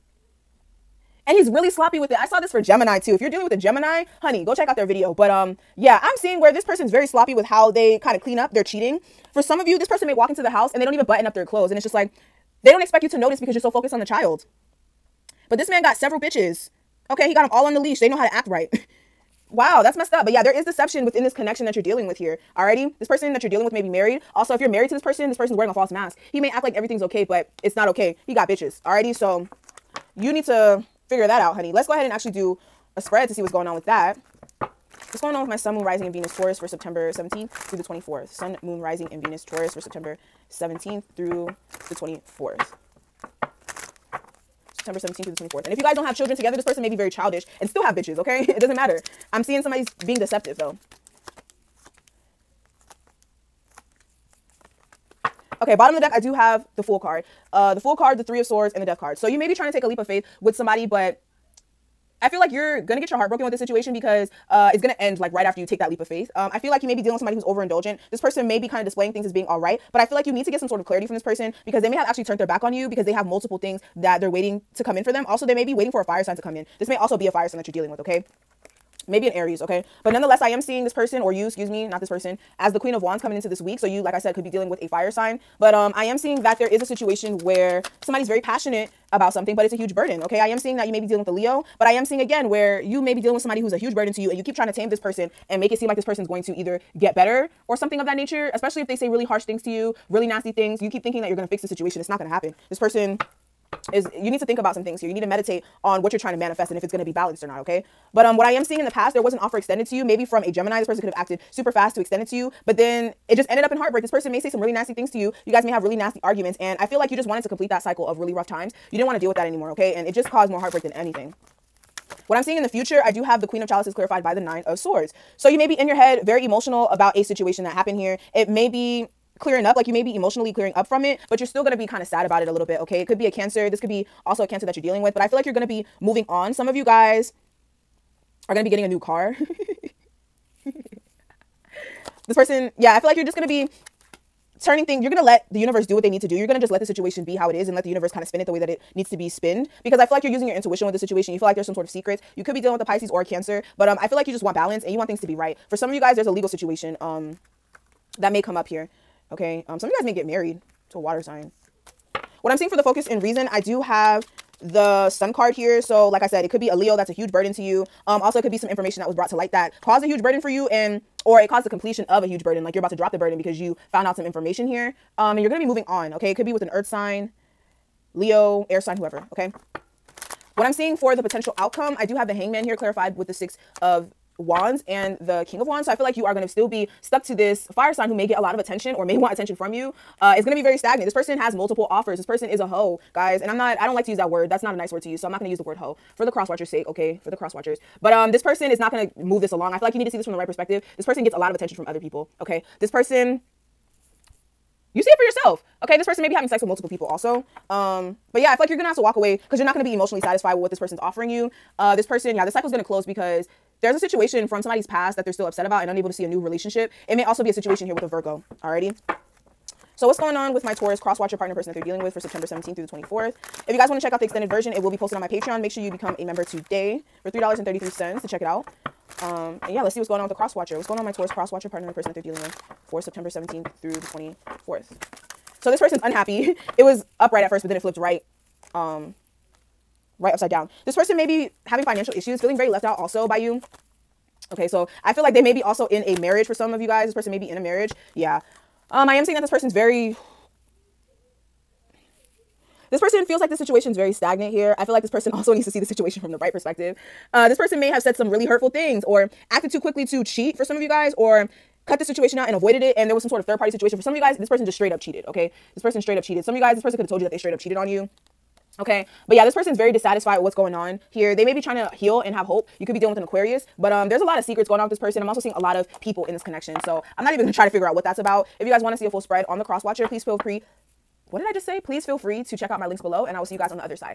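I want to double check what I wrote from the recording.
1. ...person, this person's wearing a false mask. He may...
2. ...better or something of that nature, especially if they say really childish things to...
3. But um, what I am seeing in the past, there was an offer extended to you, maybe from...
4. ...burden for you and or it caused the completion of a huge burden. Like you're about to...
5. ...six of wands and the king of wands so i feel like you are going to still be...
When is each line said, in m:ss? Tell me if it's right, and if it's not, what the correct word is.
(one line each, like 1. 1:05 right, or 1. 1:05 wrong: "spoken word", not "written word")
1. 0:25 right
2. 1:37 wrong: "harsh", not "childish"
3. 1:48 right
4. 2:50 right
5. 3:03 right.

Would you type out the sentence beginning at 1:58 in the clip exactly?
You didn't want to deal with that anymore, okay?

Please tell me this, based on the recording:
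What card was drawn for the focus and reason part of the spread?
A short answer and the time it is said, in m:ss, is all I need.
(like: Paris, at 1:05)
The Sun, at 2:44.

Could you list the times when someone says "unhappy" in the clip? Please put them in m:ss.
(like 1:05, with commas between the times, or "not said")
3:56.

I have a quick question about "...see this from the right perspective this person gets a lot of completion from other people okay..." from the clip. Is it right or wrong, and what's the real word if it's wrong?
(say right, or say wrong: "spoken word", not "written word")
wrong: "attention", not "completion".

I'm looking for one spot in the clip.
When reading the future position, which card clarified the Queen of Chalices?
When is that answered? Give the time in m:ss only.
2:04.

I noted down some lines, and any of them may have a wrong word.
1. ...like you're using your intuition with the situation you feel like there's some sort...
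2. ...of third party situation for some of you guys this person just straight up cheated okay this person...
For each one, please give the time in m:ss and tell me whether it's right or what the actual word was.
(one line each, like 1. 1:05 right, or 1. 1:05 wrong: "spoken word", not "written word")
1. 2:30 right
2. 4:23 right.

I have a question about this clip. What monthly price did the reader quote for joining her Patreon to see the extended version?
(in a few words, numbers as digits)
$3.33.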